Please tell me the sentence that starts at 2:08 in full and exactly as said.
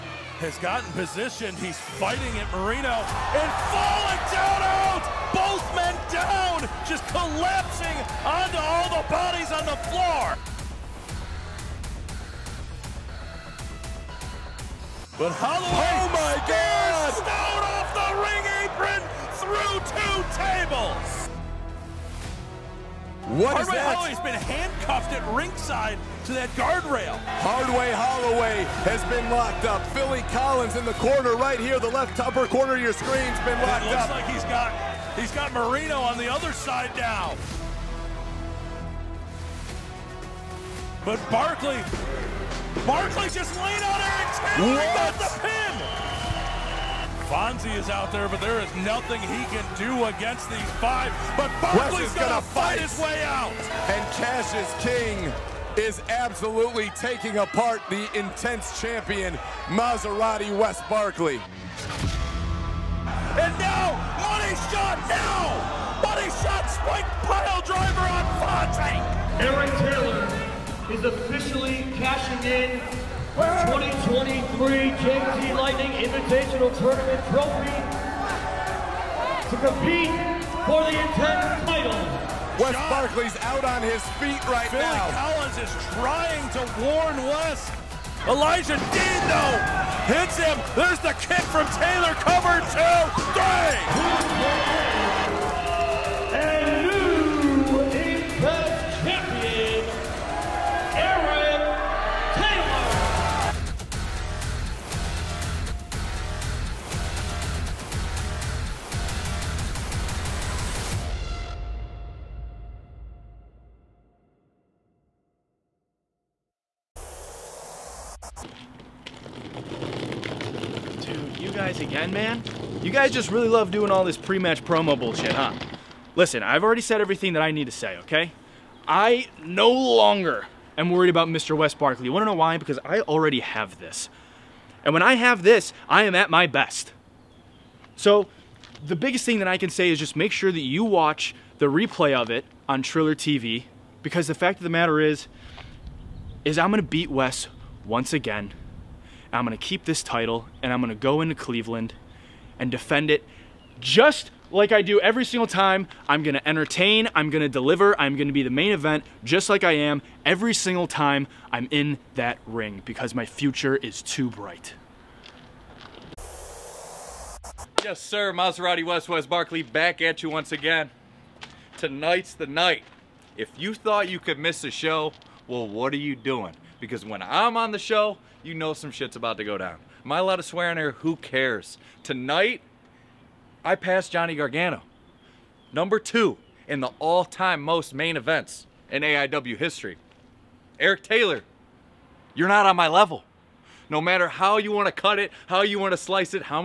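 I no longer am worried about Mr.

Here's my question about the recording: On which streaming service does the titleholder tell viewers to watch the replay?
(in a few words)
Triller TV.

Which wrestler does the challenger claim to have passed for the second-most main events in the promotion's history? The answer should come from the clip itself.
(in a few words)
Johnny Gargano.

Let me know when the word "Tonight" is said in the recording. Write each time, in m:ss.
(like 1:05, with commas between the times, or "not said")
2:51, 3:02.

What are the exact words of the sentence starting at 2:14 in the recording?
And when I have this, I am at my best.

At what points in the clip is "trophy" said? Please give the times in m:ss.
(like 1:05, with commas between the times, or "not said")
1:17.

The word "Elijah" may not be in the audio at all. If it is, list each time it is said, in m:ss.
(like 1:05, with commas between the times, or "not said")
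1:28.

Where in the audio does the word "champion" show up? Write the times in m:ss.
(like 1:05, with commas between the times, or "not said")
0:58.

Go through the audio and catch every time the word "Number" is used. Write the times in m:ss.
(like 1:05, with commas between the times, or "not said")
3:05.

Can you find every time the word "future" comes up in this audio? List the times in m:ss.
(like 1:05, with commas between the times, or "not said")
2:43.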